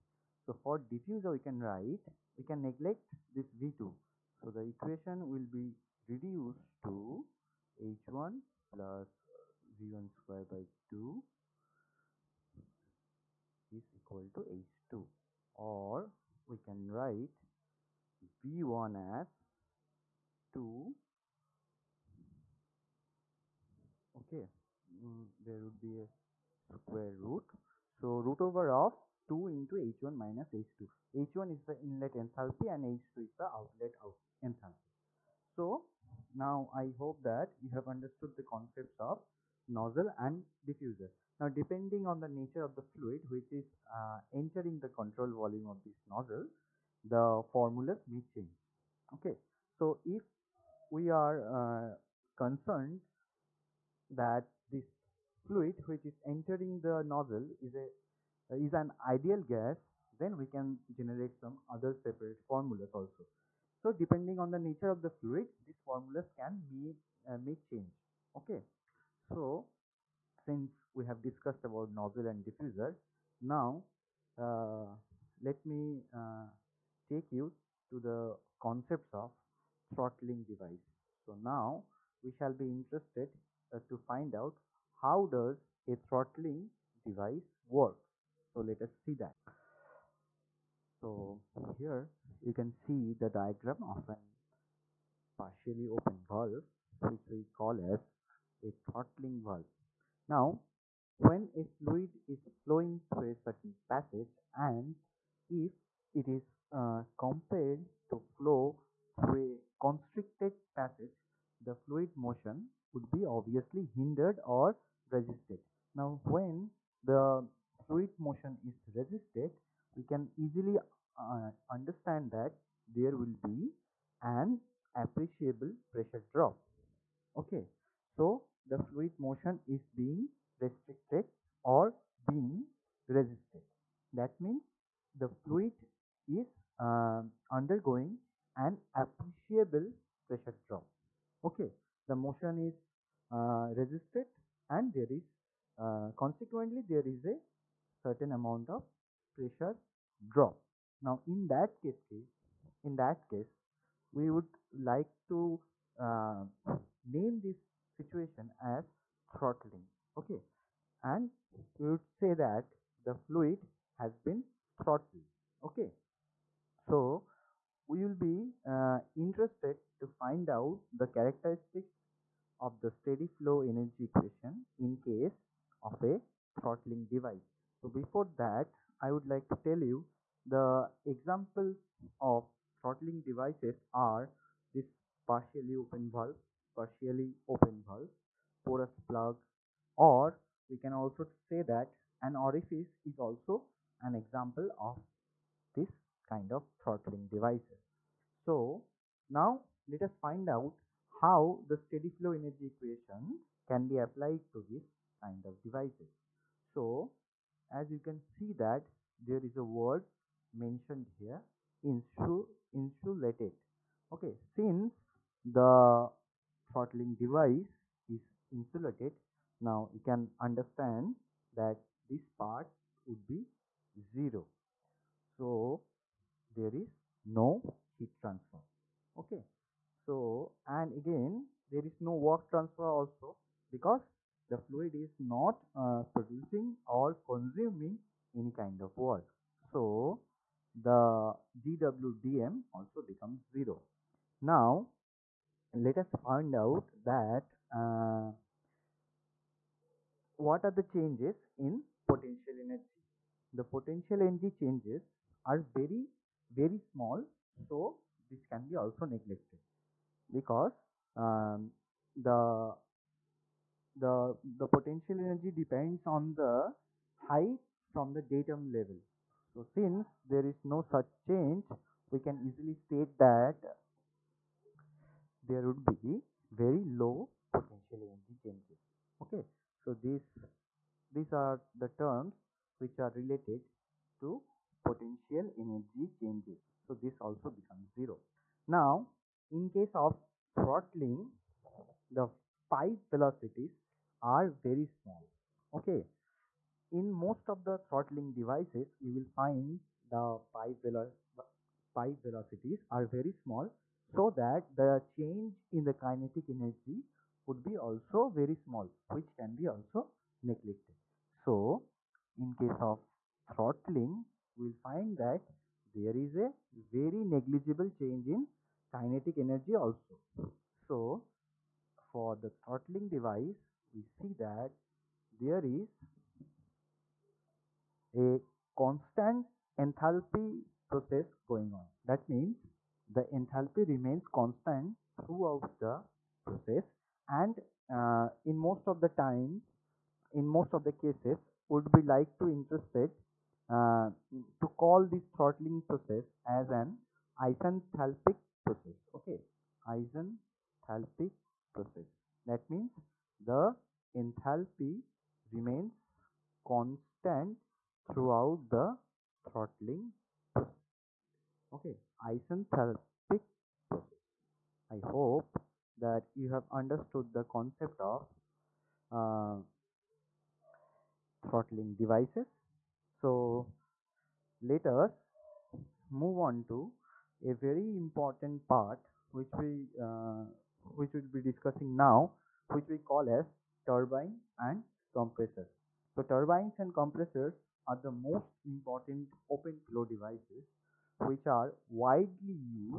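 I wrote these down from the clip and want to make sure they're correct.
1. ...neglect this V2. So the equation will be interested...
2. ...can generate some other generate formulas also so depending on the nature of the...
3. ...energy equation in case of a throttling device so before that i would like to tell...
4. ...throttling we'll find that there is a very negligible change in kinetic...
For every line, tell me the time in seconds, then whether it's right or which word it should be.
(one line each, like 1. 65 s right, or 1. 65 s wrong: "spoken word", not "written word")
1. 2 s wrong: "reduced", not "interested"
2. 60 s wrong: "separate", not "generate"
3. 173 s right
4. 313 s right.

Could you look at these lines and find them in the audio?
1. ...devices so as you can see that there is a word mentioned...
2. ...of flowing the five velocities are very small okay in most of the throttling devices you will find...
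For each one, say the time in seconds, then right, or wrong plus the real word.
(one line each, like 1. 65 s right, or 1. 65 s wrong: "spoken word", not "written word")
1. 205 s right
2. 289 s wrong: "throttling", not "flowing".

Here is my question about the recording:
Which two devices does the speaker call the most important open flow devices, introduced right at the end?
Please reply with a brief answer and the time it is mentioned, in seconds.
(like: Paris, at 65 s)
turbines and compressors, at 386 s.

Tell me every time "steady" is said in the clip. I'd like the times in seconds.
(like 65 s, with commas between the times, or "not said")
172 s, 201 s.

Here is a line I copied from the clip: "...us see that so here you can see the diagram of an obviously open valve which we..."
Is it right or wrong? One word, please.
wrong.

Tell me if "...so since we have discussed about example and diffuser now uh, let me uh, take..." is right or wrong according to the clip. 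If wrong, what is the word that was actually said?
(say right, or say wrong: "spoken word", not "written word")
wrong: "nozzle", not "example".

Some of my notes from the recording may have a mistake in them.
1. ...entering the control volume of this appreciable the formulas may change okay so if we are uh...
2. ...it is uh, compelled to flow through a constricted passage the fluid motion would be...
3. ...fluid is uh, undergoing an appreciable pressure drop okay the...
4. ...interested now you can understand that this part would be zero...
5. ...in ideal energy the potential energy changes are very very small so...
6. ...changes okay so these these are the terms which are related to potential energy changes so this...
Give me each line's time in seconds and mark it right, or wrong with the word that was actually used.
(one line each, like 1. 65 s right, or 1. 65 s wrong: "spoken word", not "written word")
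1. 44 s wrong: "nozzle", not "appreciable"
2. 106 s right
3. 135 s right
4. 218 s wrong: "insulated", not "interested"
5. 251 s wrong: "potential", not "ideal"
6. 278 s right.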